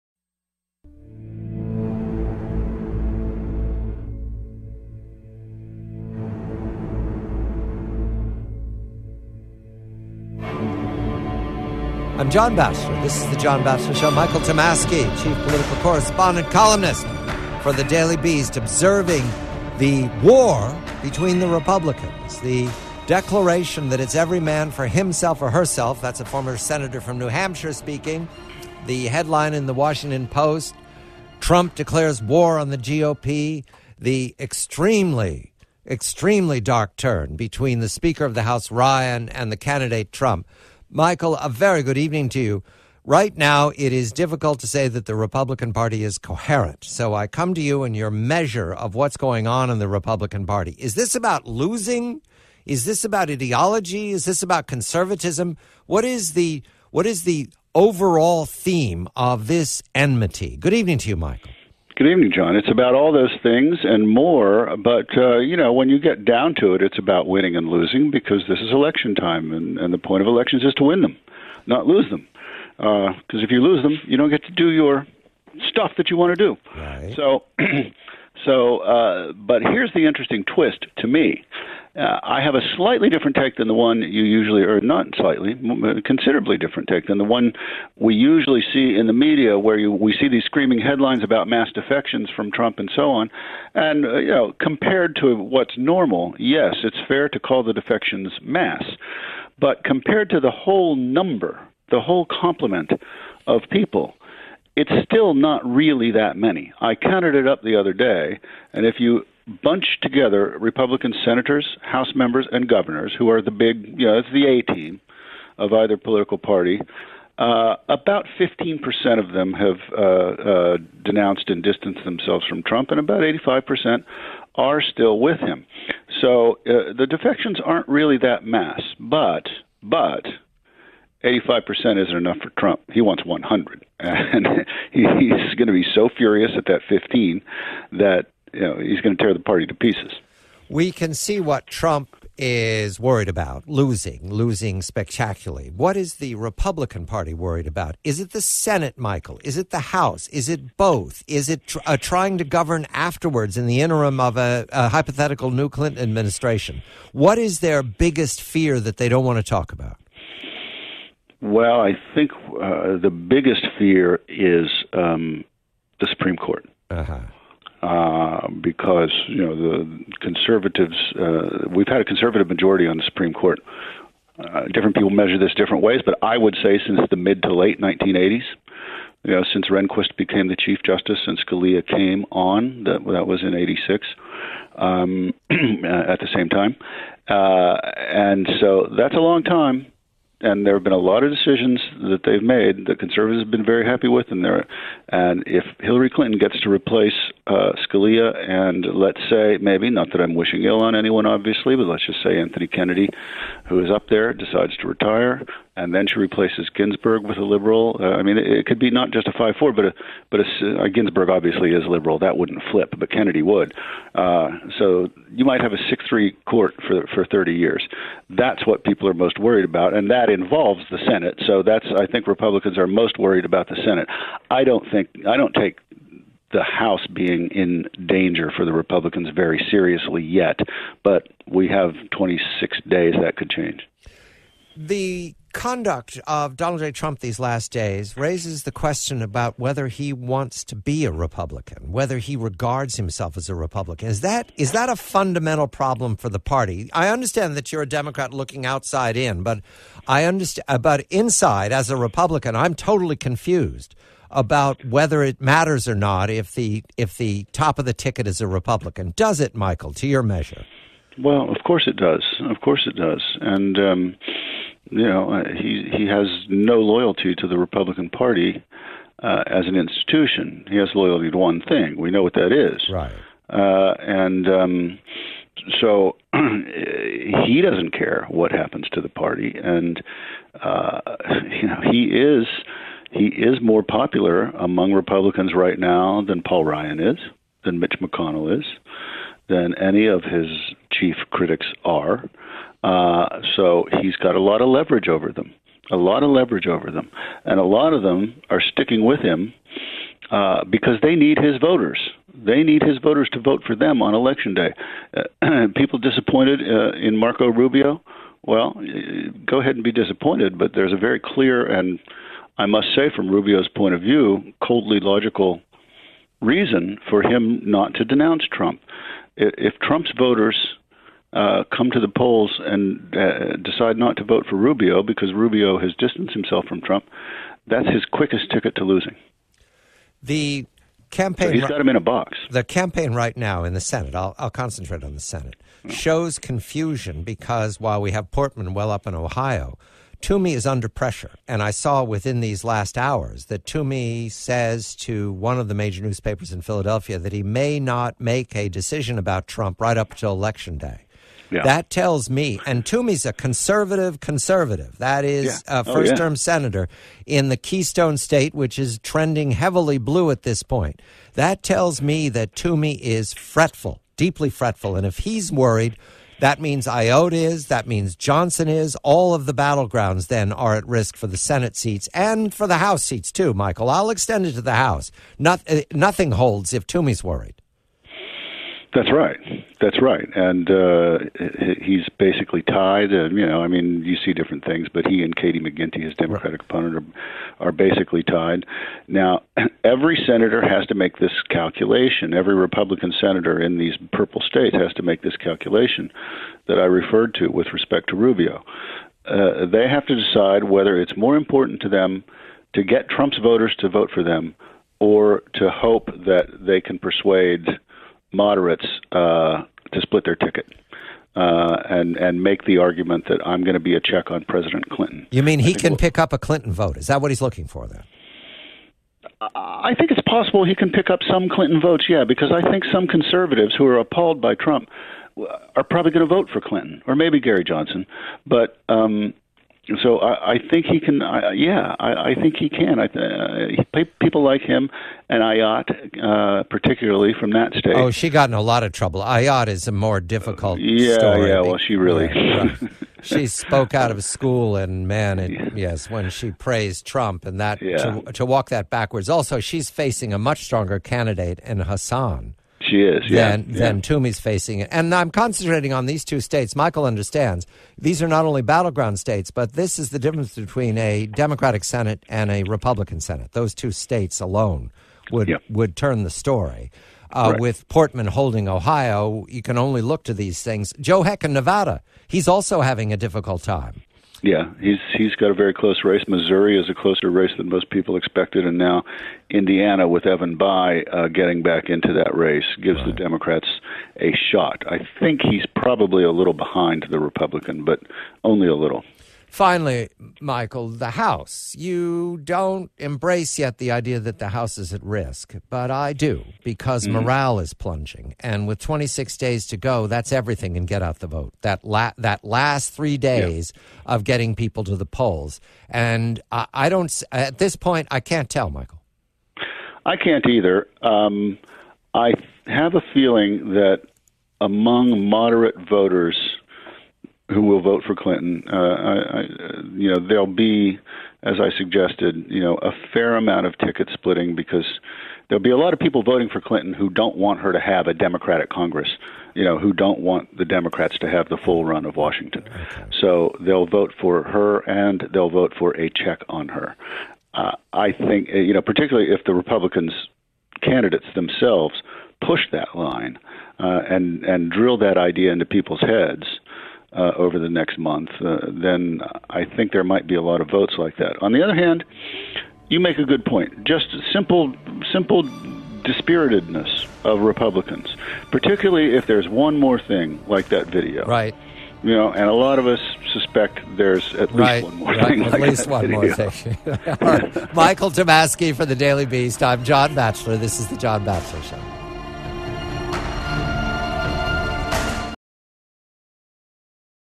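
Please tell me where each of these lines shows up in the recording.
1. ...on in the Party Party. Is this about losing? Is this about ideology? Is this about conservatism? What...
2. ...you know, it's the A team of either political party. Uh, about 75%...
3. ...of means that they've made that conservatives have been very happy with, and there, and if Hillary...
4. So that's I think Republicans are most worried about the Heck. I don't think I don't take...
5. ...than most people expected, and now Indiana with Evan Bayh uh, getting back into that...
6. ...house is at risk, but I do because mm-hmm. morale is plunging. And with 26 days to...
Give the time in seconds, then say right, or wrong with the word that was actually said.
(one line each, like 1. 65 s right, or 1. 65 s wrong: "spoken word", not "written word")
1. 49 s wrong: "Republican", not "Party"
2. 113 s wrong: "15", not "75"
3. 191 s wrong: "decisions", not "means"
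4. 221 s wrong: "Senate", not "Heck"
5. 477 s right
6. 494 s right.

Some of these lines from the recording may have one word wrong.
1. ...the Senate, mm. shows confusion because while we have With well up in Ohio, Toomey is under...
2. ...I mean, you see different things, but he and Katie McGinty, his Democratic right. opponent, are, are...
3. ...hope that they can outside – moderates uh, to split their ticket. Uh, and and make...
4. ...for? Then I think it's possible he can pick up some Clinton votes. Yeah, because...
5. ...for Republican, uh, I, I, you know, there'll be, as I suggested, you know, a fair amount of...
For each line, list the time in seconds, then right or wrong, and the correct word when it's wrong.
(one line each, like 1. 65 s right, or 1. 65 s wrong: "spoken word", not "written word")
1. 335 s wrong: "Portman", not "With"
2. 383 s right
3. 405 s wrong: "persuade", not "outside"
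4. 417 s right
5. 518 s wrong: "Clinton", not "Republican".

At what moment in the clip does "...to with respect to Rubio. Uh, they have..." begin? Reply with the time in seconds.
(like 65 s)
397 s.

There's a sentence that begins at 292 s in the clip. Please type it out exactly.
Uh, so he's got a lot of leverage over them, a lot of leverage over them.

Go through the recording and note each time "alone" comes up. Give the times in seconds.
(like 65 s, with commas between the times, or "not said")
464 s.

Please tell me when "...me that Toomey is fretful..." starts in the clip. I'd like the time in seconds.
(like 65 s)
362 s.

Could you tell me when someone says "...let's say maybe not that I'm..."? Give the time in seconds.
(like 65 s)
198 s.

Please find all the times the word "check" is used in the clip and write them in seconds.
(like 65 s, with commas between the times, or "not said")
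414 s, 536 s.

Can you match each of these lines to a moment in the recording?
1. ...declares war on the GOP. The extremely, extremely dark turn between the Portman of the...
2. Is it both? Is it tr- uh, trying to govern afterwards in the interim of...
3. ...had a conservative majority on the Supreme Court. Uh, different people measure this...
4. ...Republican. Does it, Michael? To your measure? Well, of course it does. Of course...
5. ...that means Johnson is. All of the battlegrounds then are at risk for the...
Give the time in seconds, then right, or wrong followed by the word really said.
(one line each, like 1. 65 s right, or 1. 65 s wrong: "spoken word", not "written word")
1. 31 s wrong: "Speaker", not "Portman"
2. 150 s right
3. 171 s right
4. 258 s right
5. 367 s right.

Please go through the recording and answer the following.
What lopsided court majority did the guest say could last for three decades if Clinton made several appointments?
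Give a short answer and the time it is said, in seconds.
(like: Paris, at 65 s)
6-3, at 215 s.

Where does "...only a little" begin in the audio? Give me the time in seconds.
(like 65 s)
488 s.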